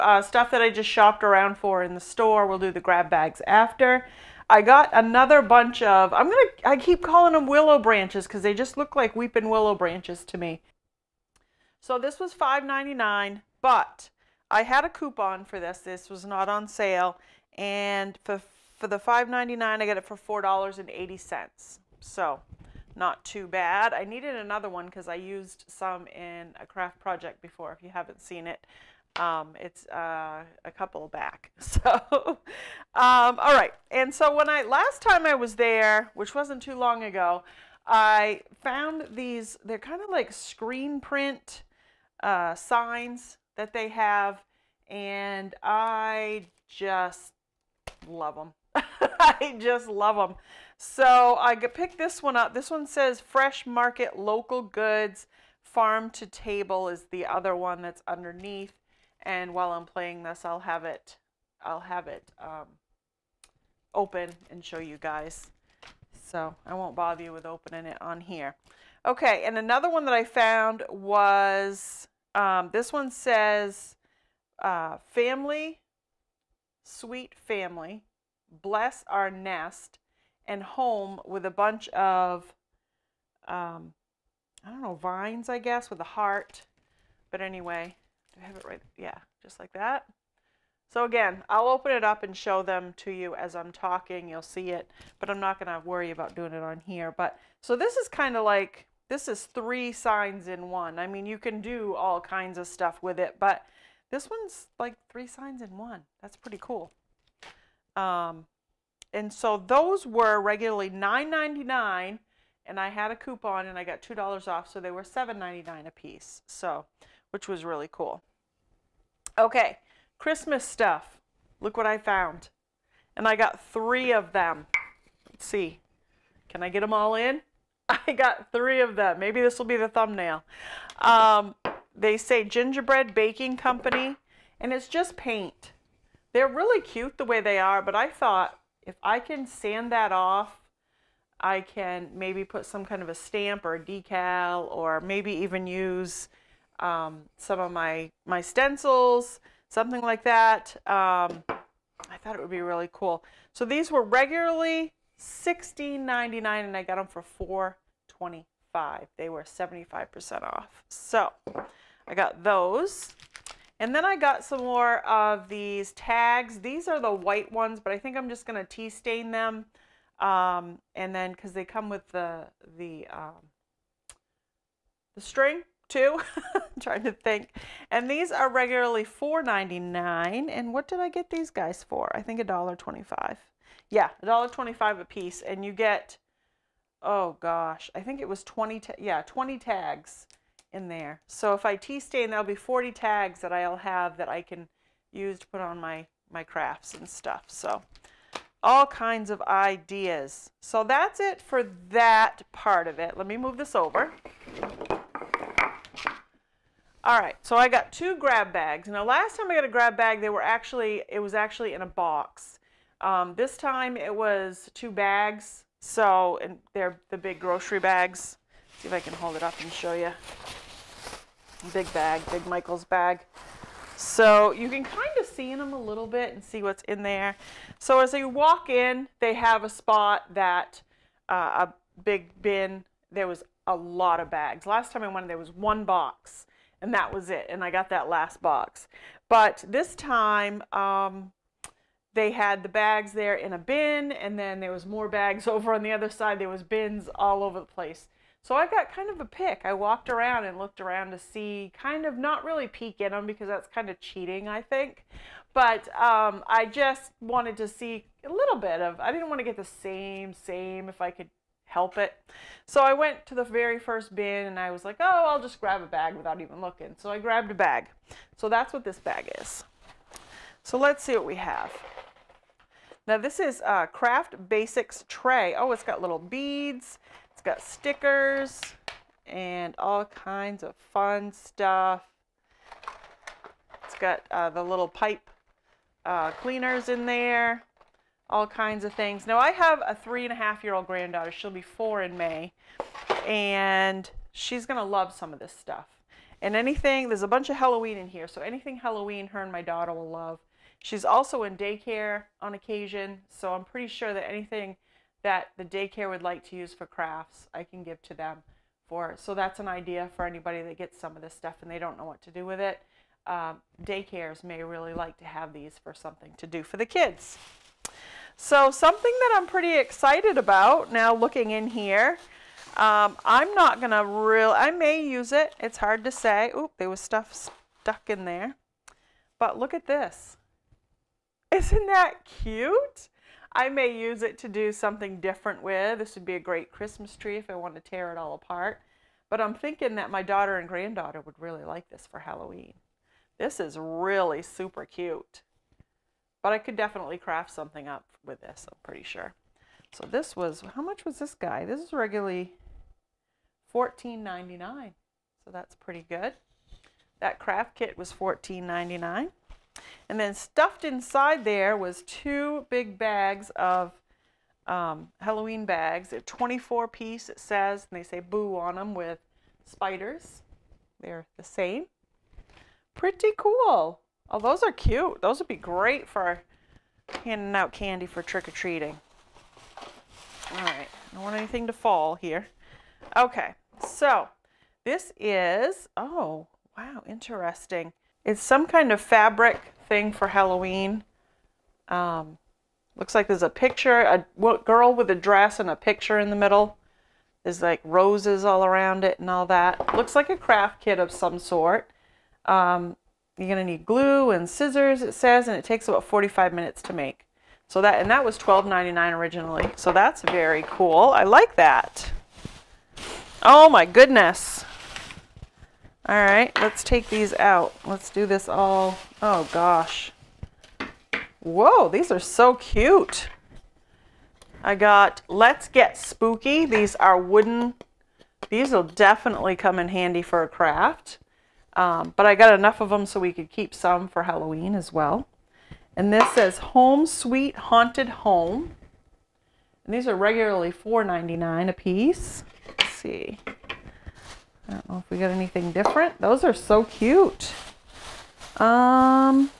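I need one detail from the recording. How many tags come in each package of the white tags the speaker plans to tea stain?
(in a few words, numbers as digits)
20.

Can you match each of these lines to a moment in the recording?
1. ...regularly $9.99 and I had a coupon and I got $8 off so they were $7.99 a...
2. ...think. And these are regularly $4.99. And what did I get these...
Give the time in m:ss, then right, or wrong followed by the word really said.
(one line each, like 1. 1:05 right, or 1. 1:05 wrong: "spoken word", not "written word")
1. 1:50 wrong: "2", not "8"
2. 2:57 right.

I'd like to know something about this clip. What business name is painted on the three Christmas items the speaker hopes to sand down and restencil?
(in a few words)
Gingerbread Baking Company.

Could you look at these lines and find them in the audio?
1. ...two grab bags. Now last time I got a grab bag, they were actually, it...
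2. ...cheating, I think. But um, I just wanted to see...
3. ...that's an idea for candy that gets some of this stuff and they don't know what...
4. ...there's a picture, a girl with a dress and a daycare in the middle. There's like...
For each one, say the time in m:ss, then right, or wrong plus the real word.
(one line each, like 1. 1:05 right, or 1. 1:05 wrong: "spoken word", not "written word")
1. 3:27 right
2. 4:14 right
3. 5:09 wrong: "anybody", not "candy"
4. 6:33 wrong: "picture", not "daycare".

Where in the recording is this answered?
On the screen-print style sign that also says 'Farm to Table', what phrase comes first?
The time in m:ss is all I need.
0:53.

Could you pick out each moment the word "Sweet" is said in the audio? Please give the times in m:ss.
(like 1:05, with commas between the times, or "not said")
1:16, 7:17.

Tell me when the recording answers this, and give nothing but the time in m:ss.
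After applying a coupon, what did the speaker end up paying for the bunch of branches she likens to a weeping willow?
0:20.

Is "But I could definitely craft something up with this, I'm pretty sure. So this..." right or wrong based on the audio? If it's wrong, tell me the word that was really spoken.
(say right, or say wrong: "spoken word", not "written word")
right.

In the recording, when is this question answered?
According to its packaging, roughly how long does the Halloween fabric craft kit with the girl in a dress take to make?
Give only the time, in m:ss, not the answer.
6:46.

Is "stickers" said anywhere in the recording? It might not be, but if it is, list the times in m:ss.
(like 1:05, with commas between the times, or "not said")
4:37.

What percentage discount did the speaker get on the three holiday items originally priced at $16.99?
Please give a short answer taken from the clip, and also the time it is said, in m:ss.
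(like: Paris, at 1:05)
75%, at 2:39.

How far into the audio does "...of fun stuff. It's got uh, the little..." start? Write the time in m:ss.
4:40.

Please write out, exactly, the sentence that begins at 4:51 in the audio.
She'll be four in May and she's going to love some of this stuff.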